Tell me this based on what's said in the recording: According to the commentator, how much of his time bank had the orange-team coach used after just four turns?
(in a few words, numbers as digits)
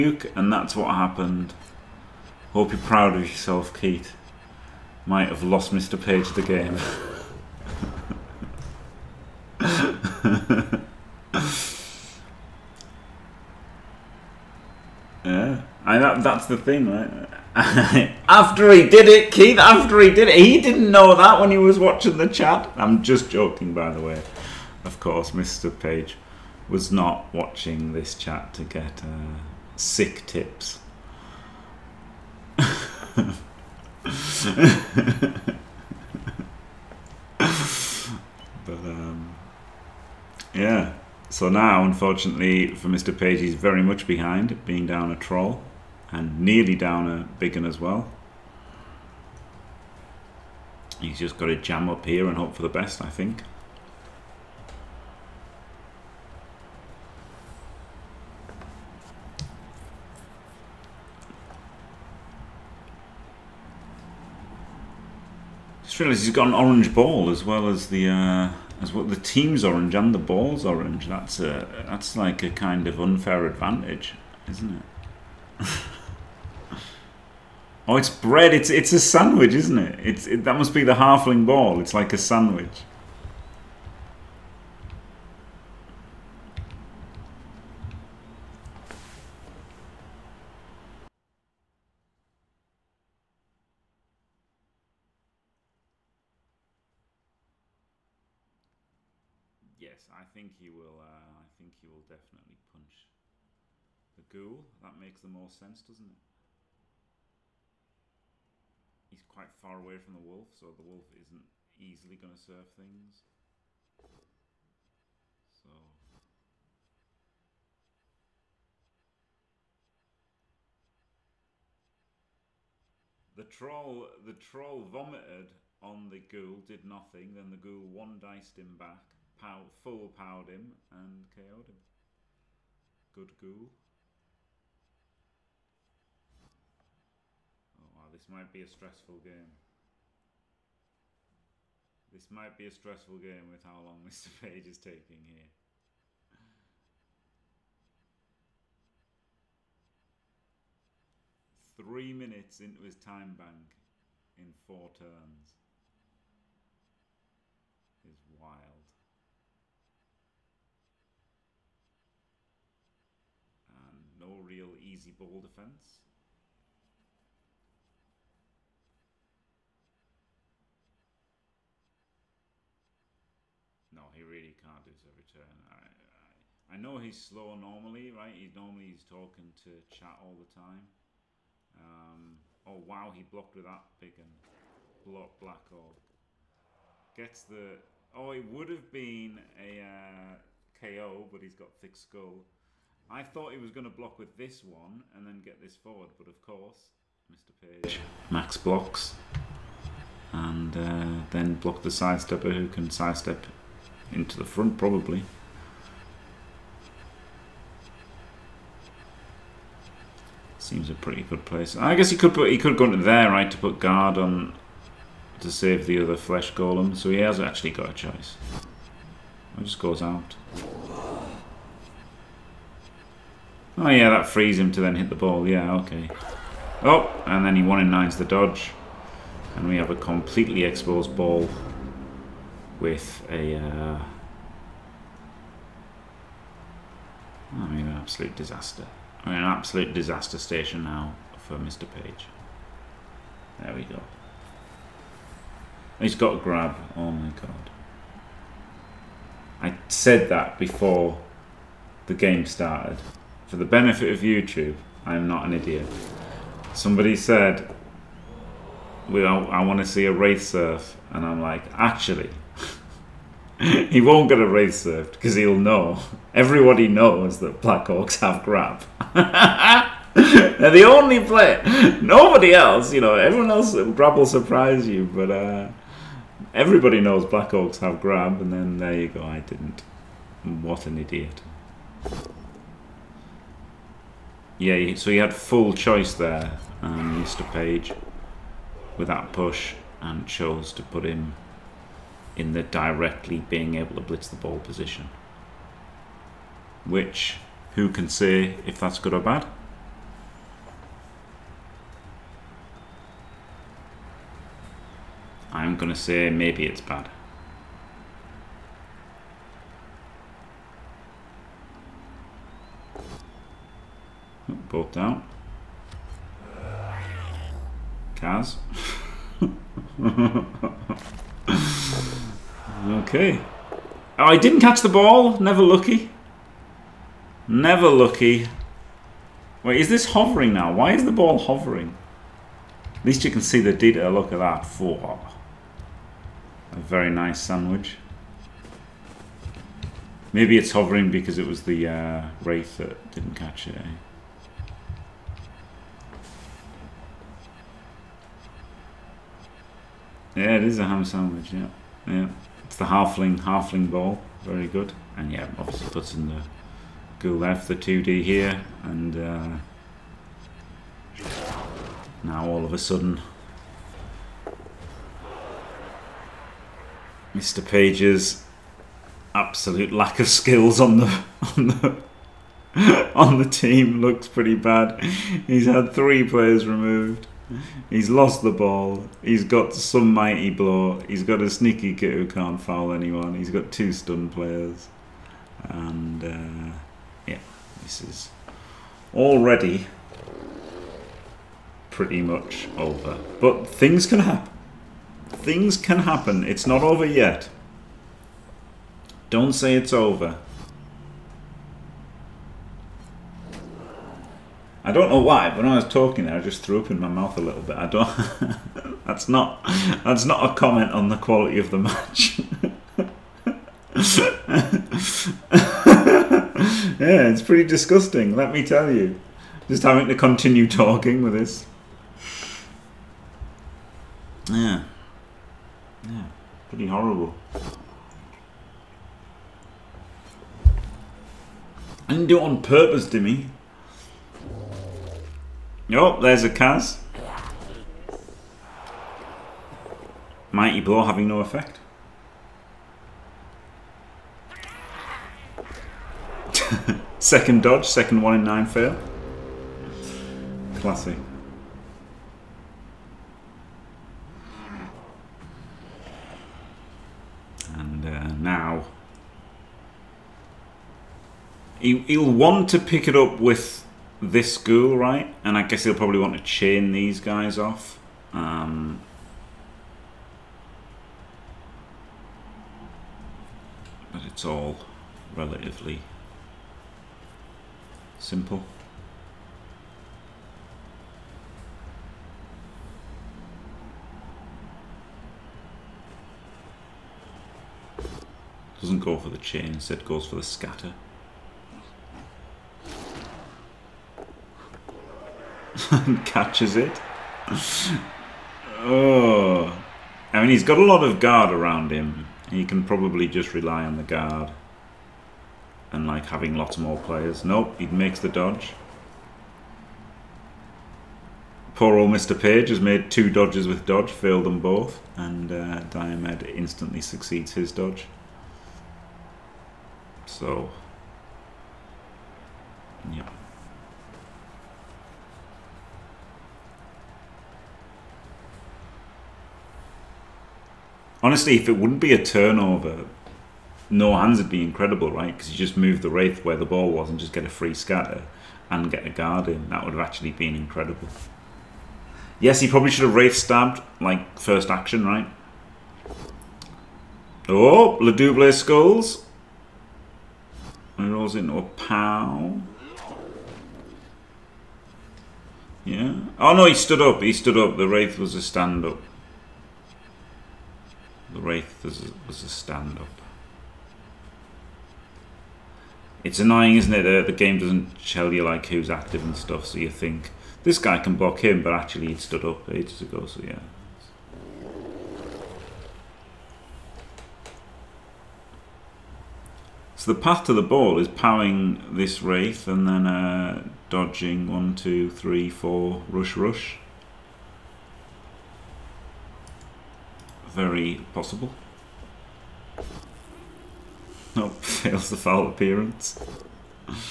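3 minutes.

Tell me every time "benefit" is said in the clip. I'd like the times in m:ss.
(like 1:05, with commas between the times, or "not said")
4:13.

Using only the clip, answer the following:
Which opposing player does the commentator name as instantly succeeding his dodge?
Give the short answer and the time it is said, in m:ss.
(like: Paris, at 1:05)
Diomed, at 8:35.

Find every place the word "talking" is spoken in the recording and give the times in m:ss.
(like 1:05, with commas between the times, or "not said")
2:59, 6:45, 7:00.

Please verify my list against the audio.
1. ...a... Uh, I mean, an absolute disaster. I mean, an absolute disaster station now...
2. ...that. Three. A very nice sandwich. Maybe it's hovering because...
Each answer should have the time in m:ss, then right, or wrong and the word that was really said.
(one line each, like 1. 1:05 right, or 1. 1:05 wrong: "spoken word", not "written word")
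1. 3:53 right
2. 5:34 wrong: "Four", not "Three".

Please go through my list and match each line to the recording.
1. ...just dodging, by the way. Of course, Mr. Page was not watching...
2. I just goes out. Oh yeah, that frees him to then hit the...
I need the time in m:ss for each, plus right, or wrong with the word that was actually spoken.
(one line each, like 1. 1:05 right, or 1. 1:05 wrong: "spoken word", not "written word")
1. 0:23 wrong: "joking", not "dodging"
2. 3:39 right.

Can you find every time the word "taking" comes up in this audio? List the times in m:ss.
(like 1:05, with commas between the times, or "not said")
2:24.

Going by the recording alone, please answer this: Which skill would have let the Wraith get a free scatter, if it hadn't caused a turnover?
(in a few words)
No hands.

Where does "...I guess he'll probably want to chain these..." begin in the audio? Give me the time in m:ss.
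7:45.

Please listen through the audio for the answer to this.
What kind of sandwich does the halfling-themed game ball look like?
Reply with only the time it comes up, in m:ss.
5:50.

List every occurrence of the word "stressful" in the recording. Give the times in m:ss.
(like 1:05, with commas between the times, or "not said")
2:18, 2:22.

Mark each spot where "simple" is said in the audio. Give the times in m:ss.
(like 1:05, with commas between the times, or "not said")
7:58.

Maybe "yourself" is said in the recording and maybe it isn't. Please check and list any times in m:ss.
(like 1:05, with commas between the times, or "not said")
0:03.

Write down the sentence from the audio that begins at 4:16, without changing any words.
Somebody said, well, I want to see a wraith surf.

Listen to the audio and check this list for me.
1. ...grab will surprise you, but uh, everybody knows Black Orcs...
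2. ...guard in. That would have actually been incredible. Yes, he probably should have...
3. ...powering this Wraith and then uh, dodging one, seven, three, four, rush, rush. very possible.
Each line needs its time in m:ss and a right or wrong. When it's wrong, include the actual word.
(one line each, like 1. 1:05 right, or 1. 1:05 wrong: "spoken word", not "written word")
1. 4:33 right
2. 8:59 right
3. 9:41 wrong: "two", not "seven".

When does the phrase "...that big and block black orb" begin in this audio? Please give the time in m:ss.
3:03.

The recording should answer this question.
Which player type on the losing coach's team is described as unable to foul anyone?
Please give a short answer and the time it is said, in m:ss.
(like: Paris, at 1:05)
Sneaky git, at 6:21.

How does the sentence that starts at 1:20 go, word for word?
It's it, that must be the halfling ball.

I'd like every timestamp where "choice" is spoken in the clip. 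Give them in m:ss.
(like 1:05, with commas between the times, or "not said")
3:37, 4:45.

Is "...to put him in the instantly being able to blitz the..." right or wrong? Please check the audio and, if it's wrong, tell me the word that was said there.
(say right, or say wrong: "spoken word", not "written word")
wrong: "directly", not "instantly".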